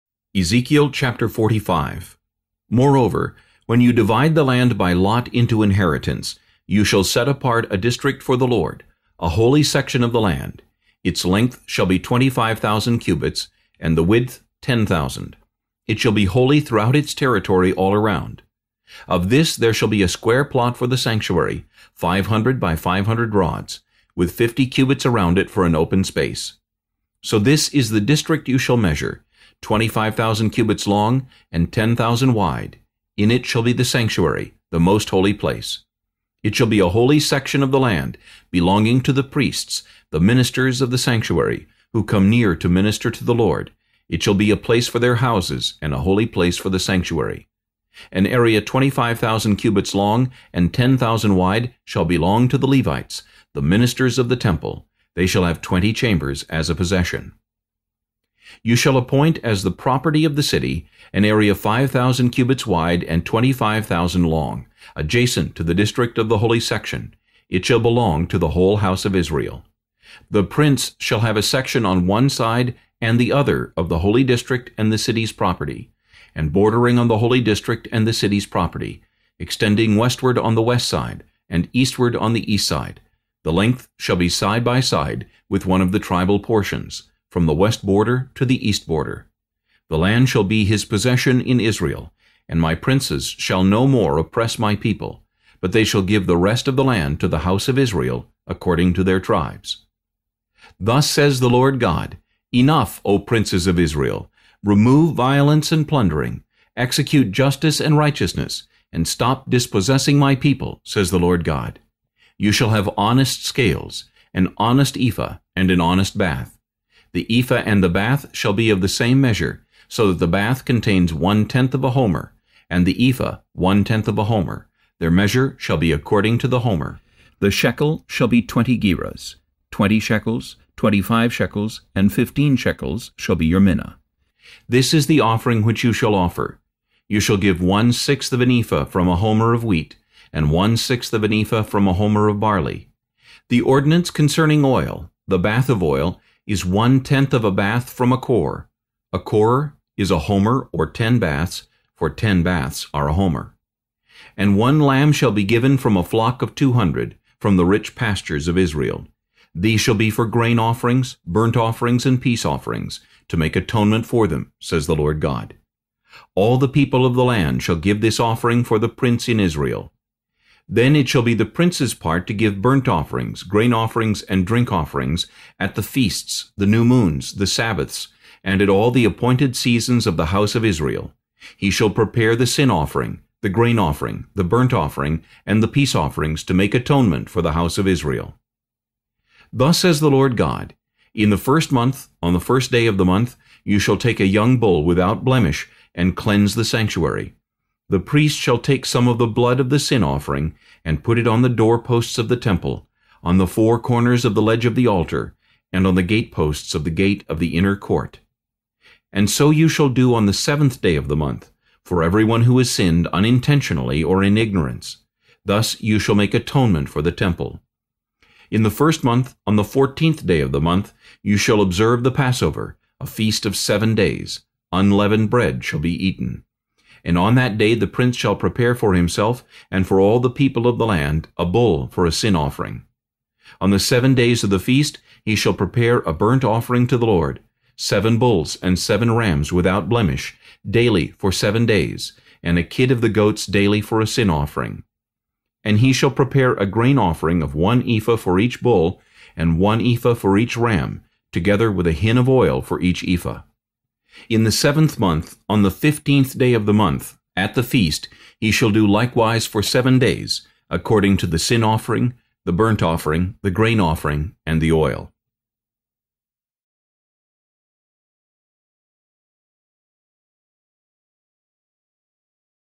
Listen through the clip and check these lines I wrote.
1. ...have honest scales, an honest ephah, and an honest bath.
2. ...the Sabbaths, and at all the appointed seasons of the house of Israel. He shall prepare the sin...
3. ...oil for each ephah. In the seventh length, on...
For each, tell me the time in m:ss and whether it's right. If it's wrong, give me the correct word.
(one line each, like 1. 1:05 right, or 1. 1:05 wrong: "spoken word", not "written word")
1. 1:52 right
2. 2:57 right
3. 4:12 wrong: "month", not "length".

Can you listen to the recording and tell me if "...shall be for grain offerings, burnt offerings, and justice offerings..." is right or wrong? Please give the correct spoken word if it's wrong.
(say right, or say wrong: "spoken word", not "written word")
wrong: "peace", not "justice".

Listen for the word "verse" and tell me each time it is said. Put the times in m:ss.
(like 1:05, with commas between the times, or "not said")
not said.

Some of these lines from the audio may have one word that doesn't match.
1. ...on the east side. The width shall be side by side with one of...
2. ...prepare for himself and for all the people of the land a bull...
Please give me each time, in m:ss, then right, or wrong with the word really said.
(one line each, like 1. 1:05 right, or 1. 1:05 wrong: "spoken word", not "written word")
1. 1:22 wrong: "length", not "width"
2. 3:48 right.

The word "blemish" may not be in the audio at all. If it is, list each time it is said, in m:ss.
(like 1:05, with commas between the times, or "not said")
3:15, 3:59.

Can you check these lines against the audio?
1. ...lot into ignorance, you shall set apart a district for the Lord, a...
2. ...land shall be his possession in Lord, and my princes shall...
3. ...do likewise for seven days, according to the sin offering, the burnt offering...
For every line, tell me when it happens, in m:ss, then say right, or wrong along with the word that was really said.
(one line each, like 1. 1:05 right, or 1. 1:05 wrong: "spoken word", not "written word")
1. 0:04 wrong: "inheritance", not "ignorance"
2. 1:29 wrong: "Israel", not "Lord"
3. 4:18 right.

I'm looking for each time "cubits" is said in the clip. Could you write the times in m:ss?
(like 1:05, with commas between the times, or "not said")
0:12, 0:24, 0:30, 0:49, 1:02.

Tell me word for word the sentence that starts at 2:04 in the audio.
Their measure shall be according to the homer.